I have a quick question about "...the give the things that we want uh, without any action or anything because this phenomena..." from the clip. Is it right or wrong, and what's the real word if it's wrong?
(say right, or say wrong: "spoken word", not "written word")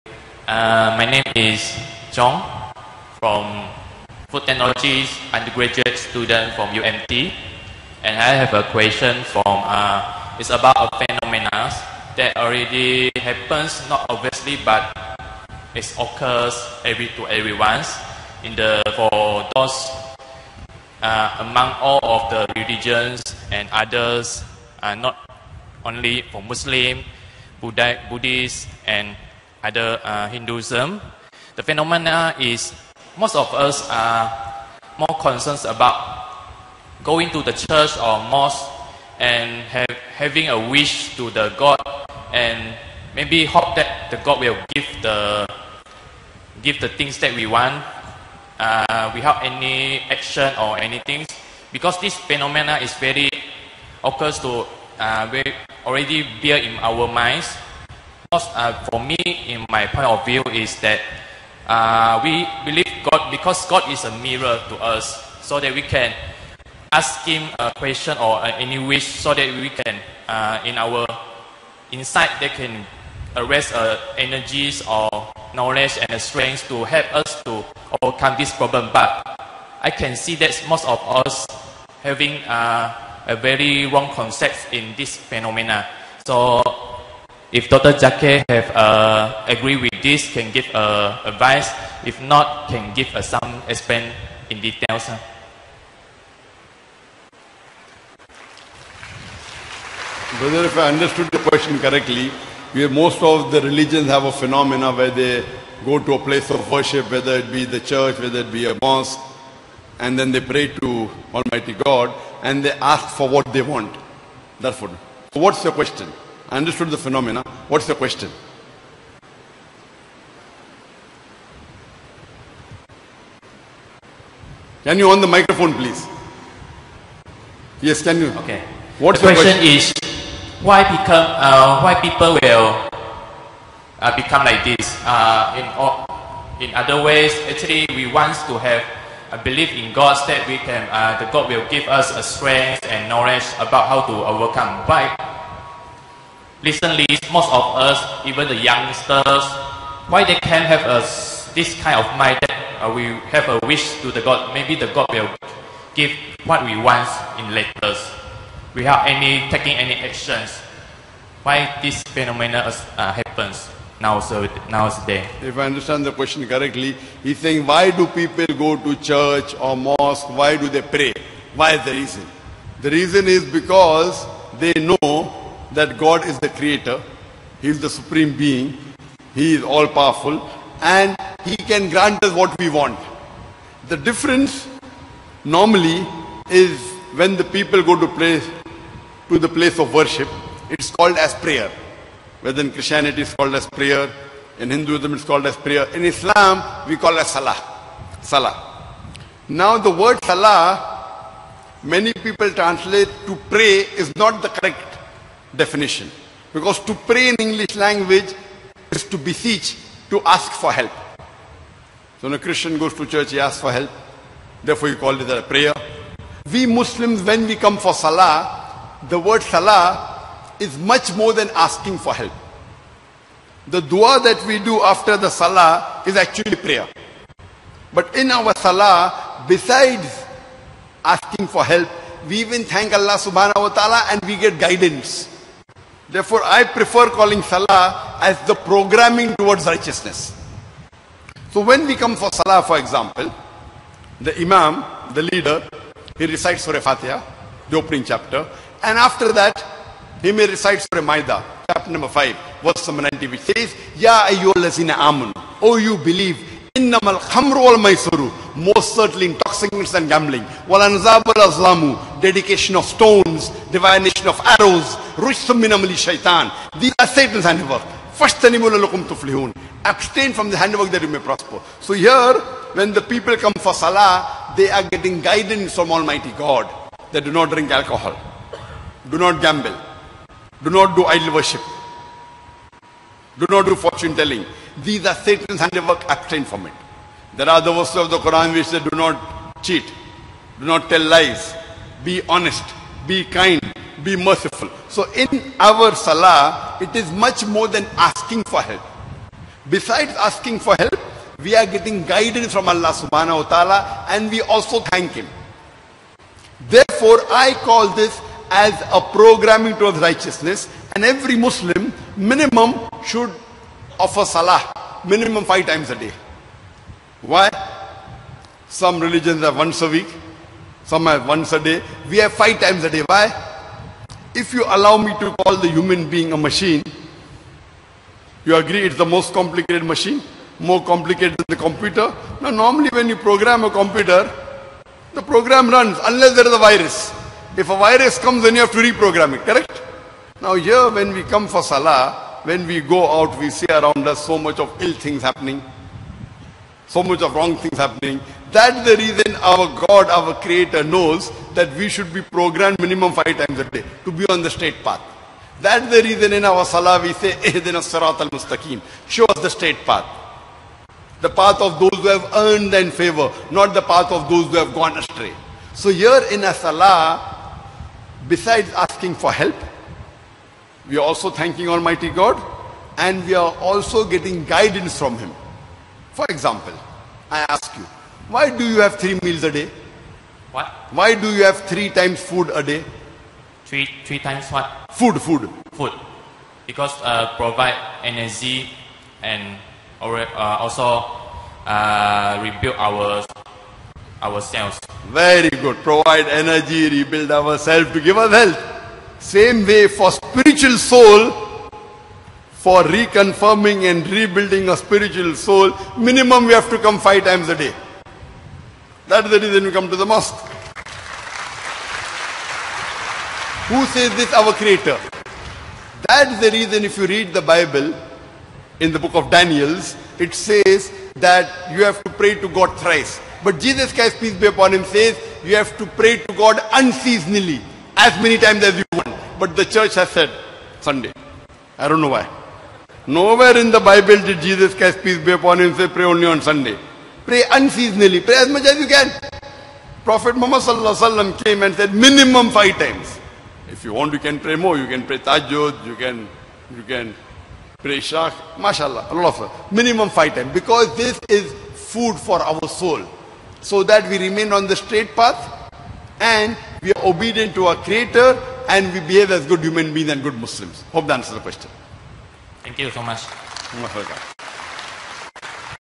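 right.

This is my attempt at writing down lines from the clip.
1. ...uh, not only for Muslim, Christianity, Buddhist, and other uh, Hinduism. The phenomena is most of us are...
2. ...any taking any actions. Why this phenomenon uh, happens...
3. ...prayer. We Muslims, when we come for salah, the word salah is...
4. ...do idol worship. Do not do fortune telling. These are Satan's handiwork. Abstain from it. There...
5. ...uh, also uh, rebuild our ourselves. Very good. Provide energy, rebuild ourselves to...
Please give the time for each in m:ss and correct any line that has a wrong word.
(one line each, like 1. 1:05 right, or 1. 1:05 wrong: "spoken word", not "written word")
1. 0:24 wrong: "Buddha", not "Christianity"
2. 2:39 right
3. 3:35 right
4. 4:40 right
5. 6:30 right.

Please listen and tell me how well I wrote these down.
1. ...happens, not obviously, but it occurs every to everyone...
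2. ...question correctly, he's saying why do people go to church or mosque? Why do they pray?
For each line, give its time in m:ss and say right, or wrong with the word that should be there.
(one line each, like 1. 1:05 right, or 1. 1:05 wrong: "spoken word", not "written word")
1. 0:13 right
2. 2:46 right.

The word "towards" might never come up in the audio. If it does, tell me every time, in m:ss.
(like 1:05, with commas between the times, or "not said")
3:59, 5:09.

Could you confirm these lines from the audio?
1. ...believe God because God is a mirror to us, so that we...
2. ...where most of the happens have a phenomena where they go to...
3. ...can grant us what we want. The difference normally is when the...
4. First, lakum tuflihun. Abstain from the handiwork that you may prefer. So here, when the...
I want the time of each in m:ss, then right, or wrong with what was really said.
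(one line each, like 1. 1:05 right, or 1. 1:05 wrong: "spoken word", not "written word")
1. 1:02 right
2. 1:42 wrong: "religions", not "happens"
3. 3:01 right
4. 4:28 wrong: "prosper", not "prefer".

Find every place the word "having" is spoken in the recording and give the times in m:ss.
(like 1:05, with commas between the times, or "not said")
0:40, 1:22.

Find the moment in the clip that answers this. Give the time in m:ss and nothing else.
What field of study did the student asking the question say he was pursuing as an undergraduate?
0:04.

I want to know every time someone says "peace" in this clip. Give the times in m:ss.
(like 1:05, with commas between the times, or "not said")
7:04, 7:15.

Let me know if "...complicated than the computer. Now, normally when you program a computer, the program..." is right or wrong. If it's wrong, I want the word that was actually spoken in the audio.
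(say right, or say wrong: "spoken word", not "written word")
right.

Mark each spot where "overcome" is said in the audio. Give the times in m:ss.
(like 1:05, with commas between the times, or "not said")
1:18, 2:24.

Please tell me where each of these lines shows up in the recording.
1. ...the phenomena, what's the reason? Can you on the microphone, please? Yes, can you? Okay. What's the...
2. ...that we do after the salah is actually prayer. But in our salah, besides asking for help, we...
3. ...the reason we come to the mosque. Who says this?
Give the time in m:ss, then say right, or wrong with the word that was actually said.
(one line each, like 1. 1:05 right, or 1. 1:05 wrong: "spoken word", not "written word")
1. 1:56 wrong: "question", not "reason"
2. 3:44 right
3. 6:49 right.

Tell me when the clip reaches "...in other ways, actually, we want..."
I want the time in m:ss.
2:16.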